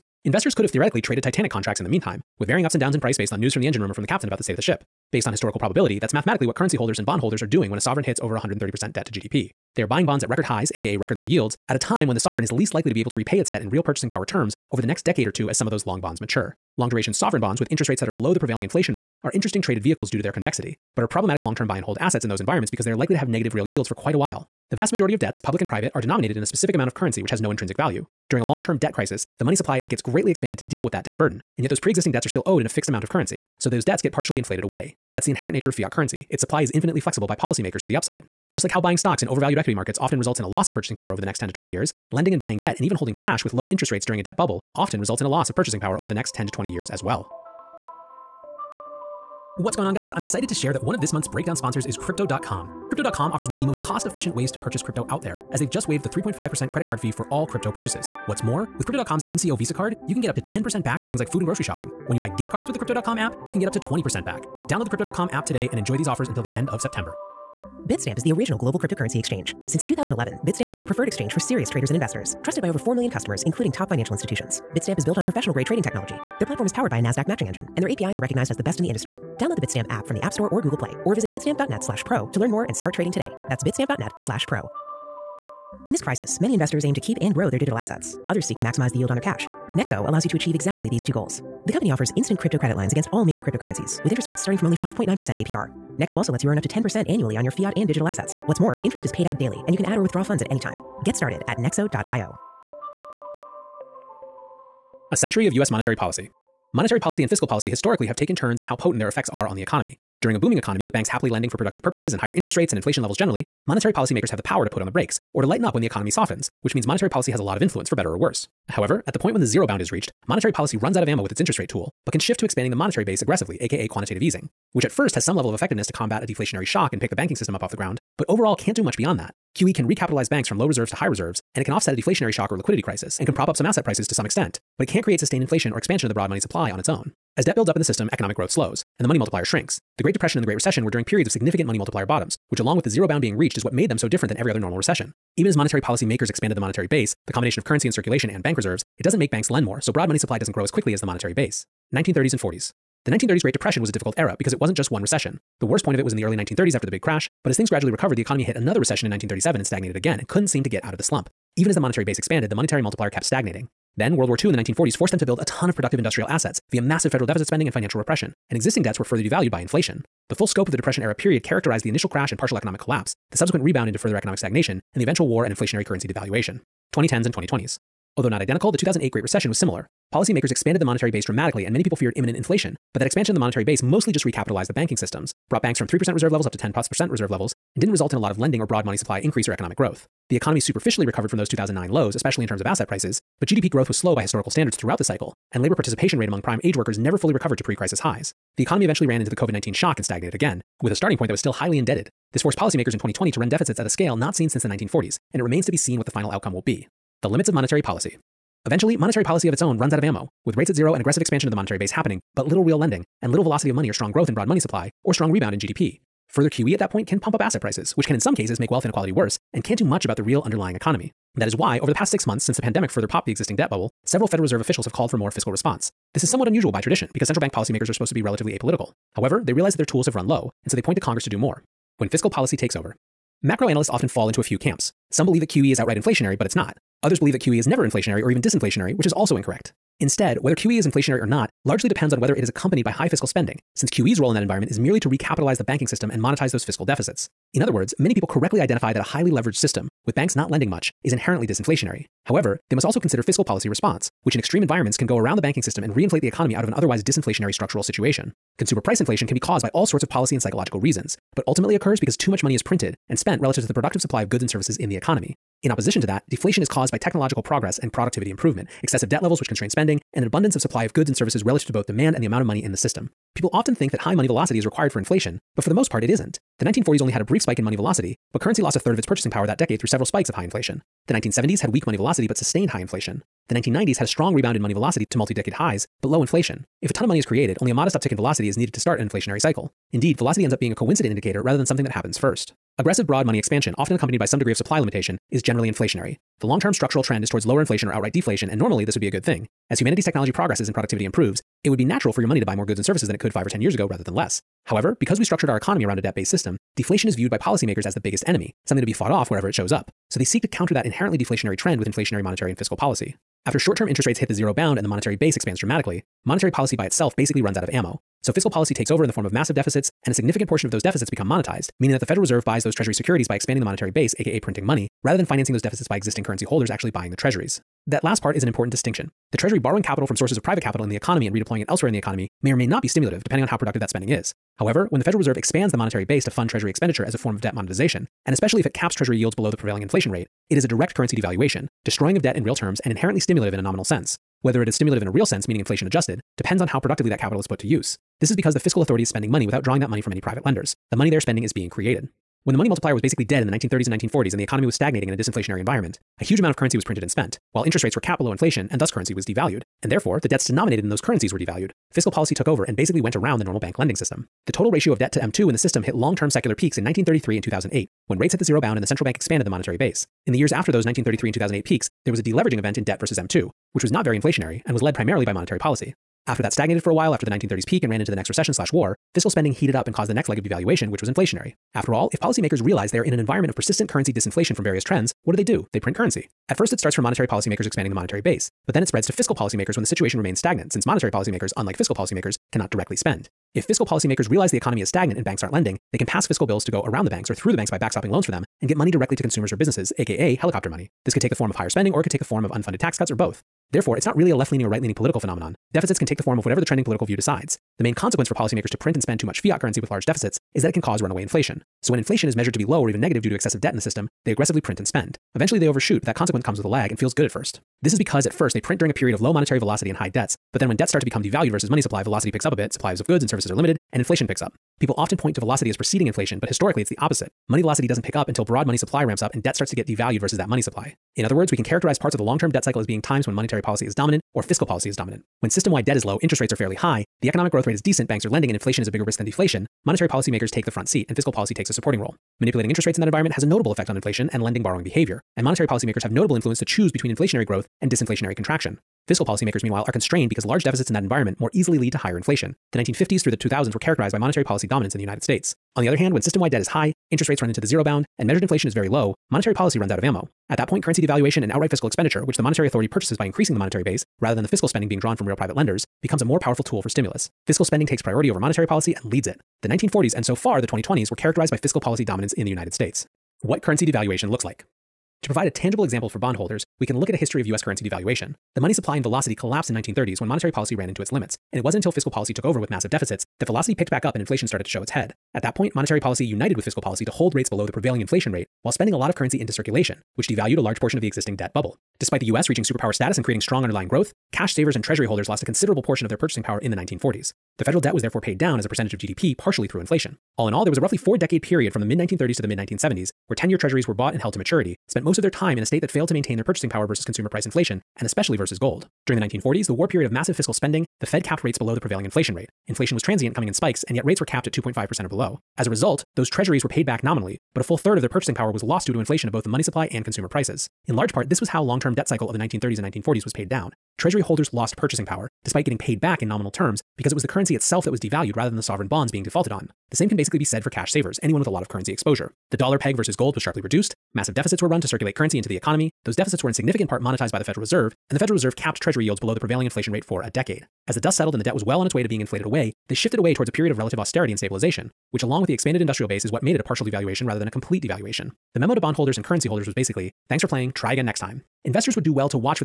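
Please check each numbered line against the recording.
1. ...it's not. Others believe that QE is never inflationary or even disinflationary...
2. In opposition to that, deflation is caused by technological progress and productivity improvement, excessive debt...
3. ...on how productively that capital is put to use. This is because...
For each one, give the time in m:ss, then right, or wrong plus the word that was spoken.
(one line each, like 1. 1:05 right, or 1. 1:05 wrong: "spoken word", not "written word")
1. 3:56 right
2. 4:25 right
3. 5:46 right.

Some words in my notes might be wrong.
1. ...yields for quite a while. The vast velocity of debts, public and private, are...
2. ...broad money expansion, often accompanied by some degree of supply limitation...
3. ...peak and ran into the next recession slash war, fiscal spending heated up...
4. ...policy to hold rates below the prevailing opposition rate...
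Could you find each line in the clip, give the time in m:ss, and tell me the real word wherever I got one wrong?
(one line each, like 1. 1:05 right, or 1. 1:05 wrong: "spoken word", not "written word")
1. 0:23 wrong: "majority", not "velocity"
2. 4:53 right
3. 6:17 right
4. 8:06 wrong: "inflation", not "opposition".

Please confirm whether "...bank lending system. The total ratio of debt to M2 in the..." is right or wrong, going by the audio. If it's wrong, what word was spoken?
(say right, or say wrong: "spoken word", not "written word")
right.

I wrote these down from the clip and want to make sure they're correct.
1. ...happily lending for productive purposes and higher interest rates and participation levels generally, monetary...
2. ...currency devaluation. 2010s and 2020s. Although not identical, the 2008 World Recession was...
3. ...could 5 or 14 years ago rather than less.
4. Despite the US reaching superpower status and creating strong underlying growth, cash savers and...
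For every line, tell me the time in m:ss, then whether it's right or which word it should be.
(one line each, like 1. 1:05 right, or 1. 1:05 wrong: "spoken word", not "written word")
1. 1:51 wrong: "inflation", not "participation"
2. 2:55 wrong: "Great", not "World"
3. 5:03 wrong: "10", not "14"
4. 8:12 right.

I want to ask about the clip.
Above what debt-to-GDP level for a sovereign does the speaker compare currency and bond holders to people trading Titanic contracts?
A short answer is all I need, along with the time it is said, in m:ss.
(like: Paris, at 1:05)
130%, at 0:08.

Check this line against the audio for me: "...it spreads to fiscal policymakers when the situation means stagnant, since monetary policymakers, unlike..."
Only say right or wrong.
wrong.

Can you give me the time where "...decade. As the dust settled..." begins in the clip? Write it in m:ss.
9:00.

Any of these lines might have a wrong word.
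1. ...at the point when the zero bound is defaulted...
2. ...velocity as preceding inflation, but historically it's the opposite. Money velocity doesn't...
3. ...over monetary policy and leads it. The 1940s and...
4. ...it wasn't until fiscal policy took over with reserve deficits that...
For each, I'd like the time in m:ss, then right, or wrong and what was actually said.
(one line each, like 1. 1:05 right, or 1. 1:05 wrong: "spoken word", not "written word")
1. 1:59 wrong: "reached", not "defaulted"
2. 7:05 right
3. 7:48 right
4. 8:01 wrong: "massive", not "reserve".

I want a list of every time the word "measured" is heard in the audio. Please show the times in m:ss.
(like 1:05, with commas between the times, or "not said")
6:52, 7:38.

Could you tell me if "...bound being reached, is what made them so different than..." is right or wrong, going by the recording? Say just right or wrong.
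right.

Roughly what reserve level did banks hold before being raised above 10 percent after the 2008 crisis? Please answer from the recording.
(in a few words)
3%.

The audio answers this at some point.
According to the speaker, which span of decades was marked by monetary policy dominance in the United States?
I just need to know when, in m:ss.
7:32.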